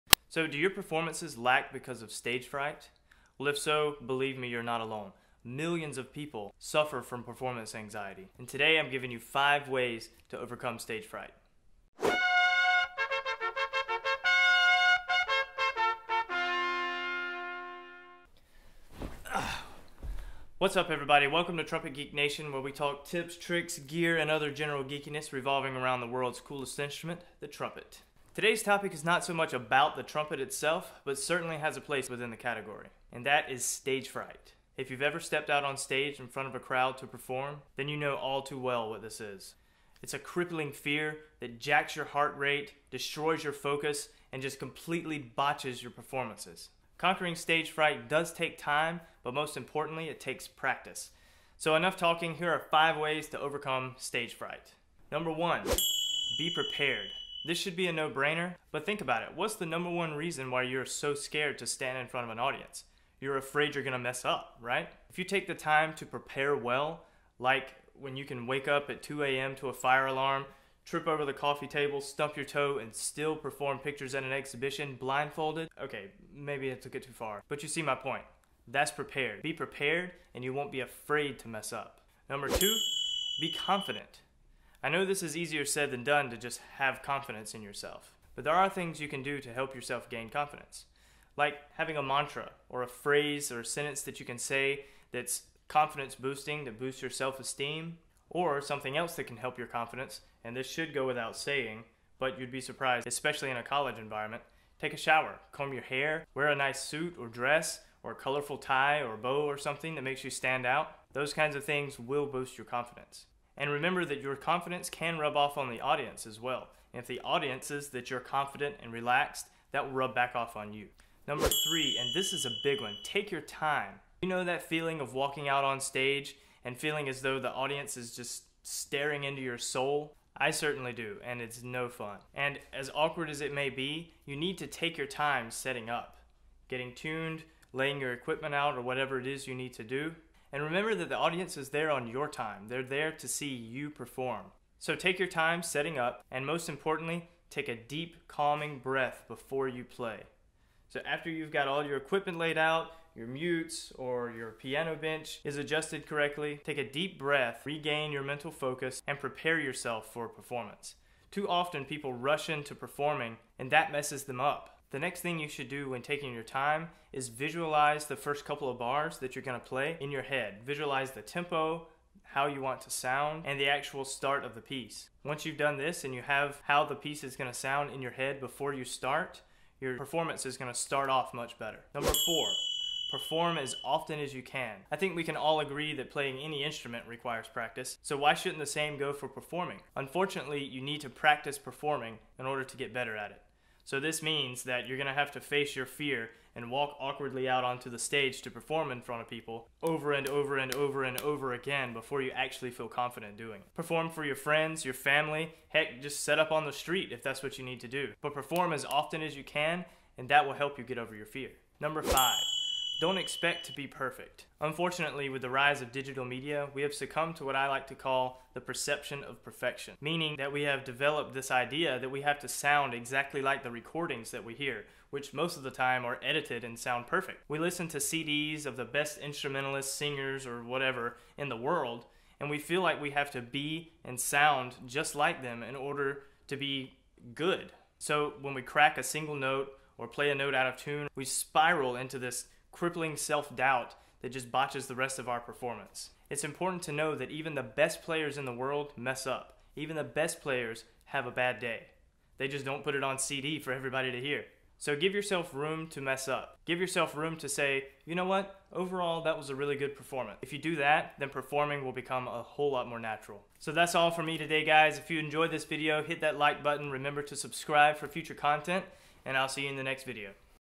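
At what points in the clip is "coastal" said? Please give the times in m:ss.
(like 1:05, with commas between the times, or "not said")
not said.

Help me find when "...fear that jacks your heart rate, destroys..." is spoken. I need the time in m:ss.
0:40.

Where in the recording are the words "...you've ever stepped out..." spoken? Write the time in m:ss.
0:34.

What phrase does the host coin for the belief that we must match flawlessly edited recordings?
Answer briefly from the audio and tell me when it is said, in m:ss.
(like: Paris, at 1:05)
perception of perfection, at 3:38.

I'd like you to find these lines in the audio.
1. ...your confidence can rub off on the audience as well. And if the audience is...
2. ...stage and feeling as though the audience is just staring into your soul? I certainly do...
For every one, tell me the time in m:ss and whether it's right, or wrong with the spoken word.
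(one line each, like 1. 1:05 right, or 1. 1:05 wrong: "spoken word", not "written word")
1. 1:54 right
2. 2:05 right.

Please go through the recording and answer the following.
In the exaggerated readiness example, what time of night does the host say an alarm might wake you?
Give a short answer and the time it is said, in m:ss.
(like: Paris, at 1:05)
2 a.m., at 1:09.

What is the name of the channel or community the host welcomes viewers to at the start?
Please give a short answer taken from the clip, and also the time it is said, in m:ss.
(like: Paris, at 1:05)
Trumpet Geek Nation, at 0:21.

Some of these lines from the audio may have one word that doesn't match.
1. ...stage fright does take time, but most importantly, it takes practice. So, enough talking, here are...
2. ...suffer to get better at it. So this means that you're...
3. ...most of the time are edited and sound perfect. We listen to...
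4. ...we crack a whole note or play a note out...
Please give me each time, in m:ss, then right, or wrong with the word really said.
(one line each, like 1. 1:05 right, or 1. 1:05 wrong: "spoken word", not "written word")
1. 0:47 right
2. 3:12 wrong: "order", not "suffer"
3. 3:45 right
4. 3:58 wrong: "single", not "whole".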